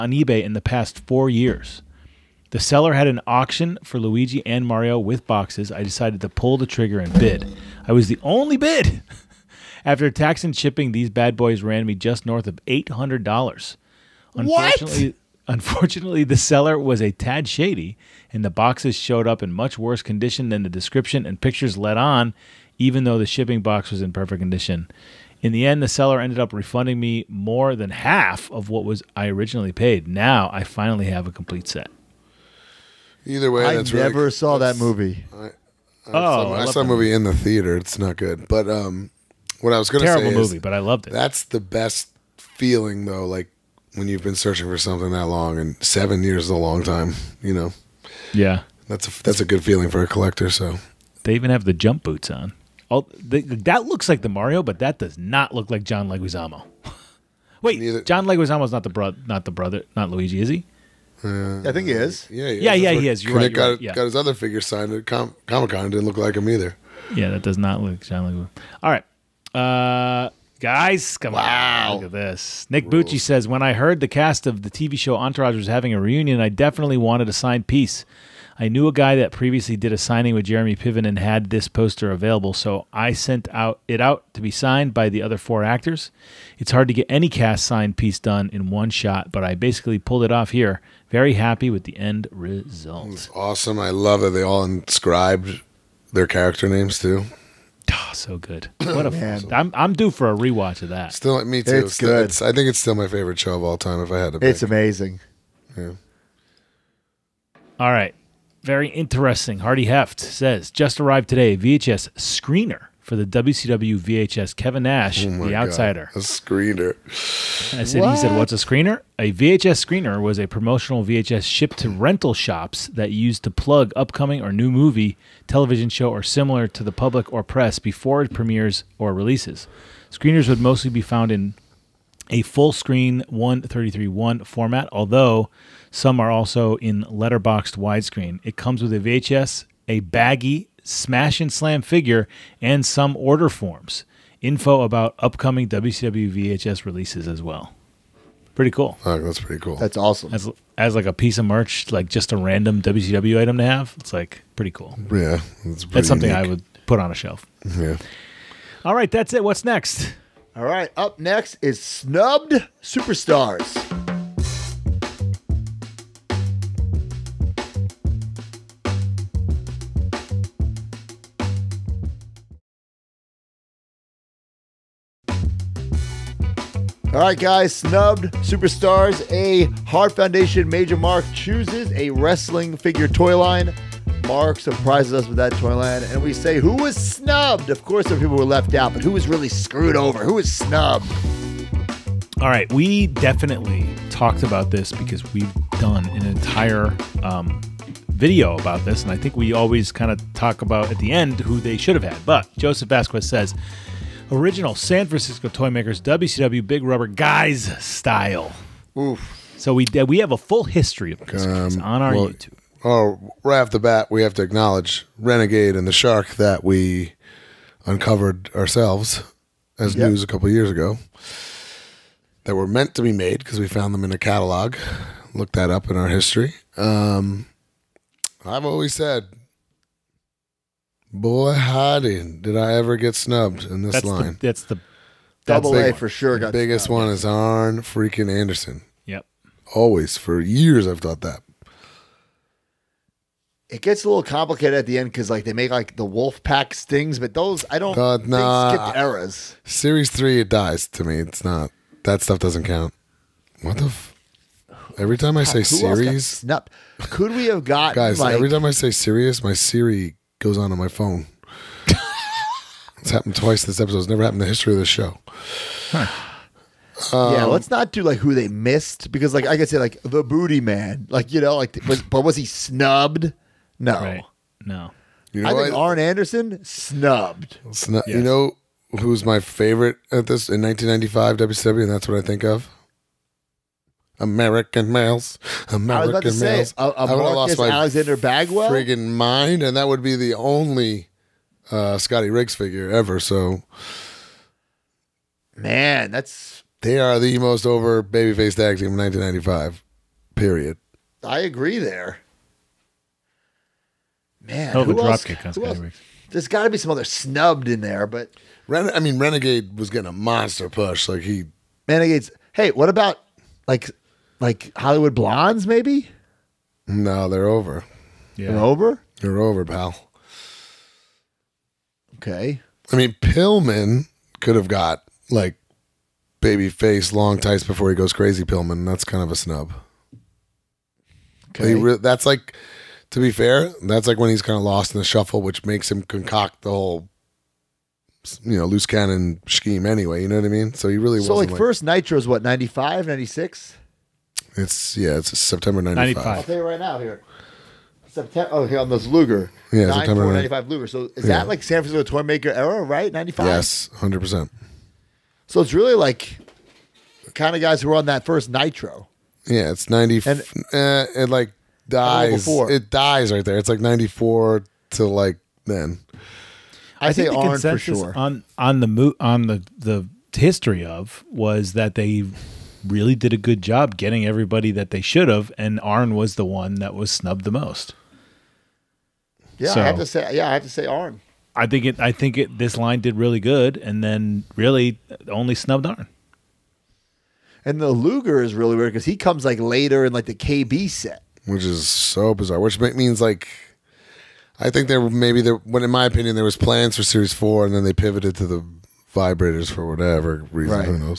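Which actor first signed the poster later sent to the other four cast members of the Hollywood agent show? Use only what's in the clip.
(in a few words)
Jeremy Piven.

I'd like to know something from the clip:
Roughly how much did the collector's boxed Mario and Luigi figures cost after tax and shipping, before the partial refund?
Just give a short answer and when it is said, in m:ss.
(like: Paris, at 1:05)
just north of $800, at 0:11.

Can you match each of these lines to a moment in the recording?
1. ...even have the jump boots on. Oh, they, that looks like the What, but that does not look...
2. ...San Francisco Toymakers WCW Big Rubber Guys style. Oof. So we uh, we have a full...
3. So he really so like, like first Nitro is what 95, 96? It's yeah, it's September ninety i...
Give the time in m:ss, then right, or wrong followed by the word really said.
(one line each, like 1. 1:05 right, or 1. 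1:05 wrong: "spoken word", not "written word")
1. 0:51 wrong: "Mario", not "What"
2. 3:24 right
3. 5:40 right.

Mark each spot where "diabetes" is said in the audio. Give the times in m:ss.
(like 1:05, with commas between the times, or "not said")
not said.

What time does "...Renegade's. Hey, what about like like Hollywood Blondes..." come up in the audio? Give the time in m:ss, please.
5:11.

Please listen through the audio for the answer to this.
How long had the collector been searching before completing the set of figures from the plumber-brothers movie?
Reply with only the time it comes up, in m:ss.
0:45.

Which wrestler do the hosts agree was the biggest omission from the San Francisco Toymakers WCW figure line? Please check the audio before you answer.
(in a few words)
Arn Anderson.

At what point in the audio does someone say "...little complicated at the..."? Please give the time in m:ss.
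4:04.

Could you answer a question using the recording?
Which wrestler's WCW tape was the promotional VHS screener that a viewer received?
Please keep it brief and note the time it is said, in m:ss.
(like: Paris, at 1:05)
Kevin Nash, at 1:54.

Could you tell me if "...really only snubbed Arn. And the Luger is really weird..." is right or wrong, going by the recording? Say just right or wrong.
right.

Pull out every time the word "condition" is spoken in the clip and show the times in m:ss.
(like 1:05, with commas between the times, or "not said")
0:20, 0:24.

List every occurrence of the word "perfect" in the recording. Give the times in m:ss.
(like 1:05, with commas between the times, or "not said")
0:24.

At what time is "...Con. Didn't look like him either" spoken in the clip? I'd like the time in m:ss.
1:05.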